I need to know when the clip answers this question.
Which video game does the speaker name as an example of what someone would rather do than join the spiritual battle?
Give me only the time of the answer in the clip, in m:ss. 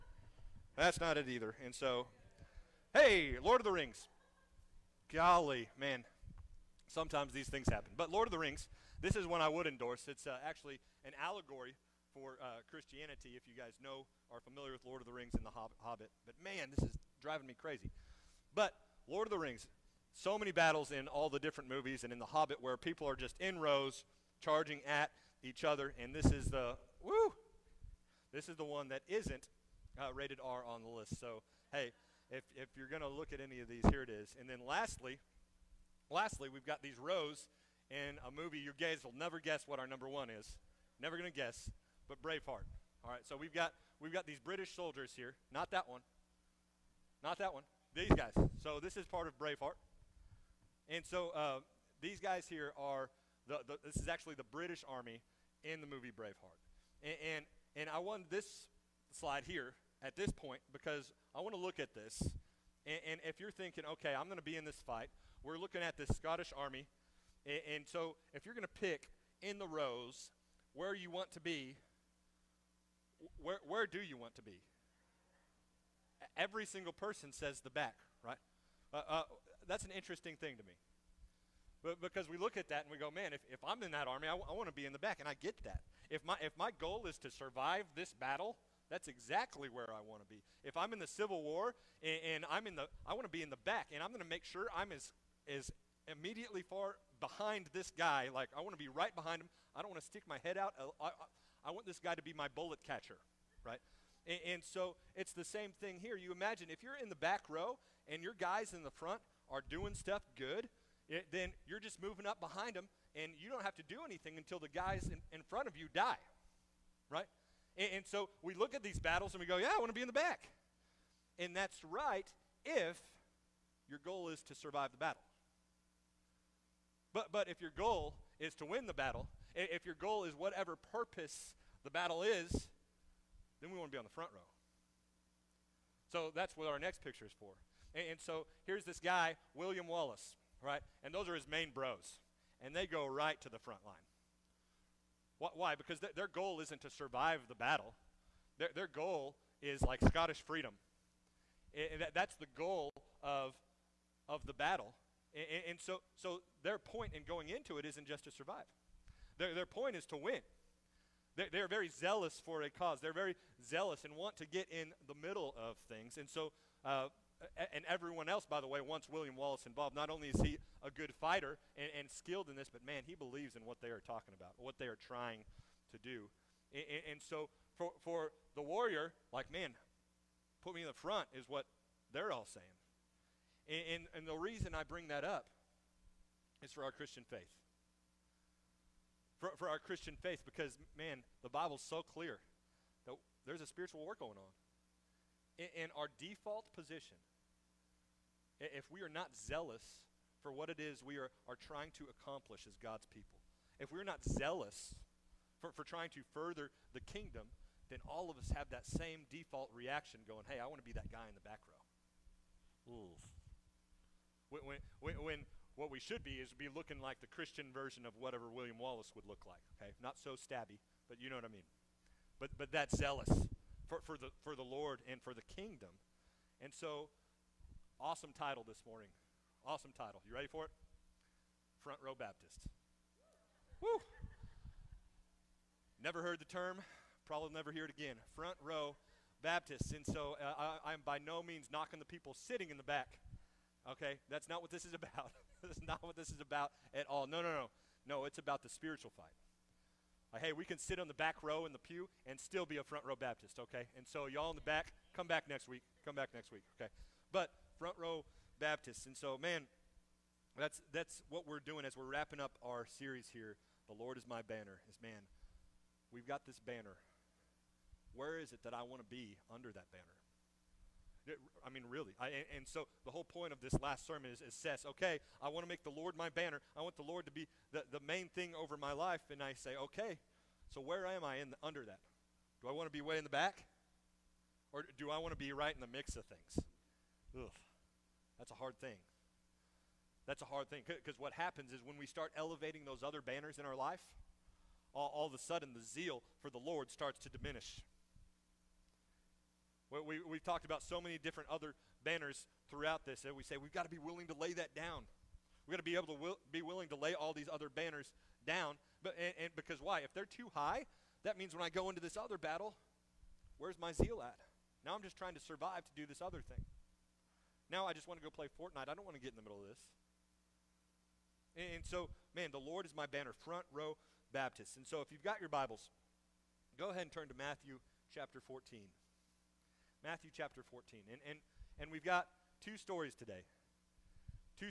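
5:18.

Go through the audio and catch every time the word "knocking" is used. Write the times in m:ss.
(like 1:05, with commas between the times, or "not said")
4:01.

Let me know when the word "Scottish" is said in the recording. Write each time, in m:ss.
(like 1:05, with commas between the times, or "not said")
1:06, 2:30.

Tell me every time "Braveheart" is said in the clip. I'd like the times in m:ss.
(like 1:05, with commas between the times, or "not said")
0:42, 0:49, 0:56.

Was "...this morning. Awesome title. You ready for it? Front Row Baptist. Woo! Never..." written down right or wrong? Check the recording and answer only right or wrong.
right.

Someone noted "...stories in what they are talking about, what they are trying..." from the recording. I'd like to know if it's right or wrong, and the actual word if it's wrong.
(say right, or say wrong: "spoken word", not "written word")
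wrong: "believes", not "stories".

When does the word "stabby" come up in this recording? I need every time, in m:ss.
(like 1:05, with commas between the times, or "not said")
3:40.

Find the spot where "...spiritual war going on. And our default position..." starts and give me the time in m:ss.
3:13.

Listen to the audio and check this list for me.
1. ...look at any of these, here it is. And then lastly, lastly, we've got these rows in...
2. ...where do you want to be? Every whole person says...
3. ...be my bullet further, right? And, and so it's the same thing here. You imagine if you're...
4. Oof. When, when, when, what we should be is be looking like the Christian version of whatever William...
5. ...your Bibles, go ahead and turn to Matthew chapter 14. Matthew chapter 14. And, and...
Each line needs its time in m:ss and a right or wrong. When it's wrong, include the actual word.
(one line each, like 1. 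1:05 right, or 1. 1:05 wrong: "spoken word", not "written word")
1. 0:33 right
2. 1:13 wrong: "single", not "whole"
3. 1:42 wrong: "catcher", not "further"
4. 3:32 right
5. 5:25 right.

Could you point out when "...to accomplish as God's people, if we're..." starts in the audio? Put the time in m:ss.
3:21.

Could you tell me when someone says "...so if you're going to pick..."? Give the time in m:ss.
1:07.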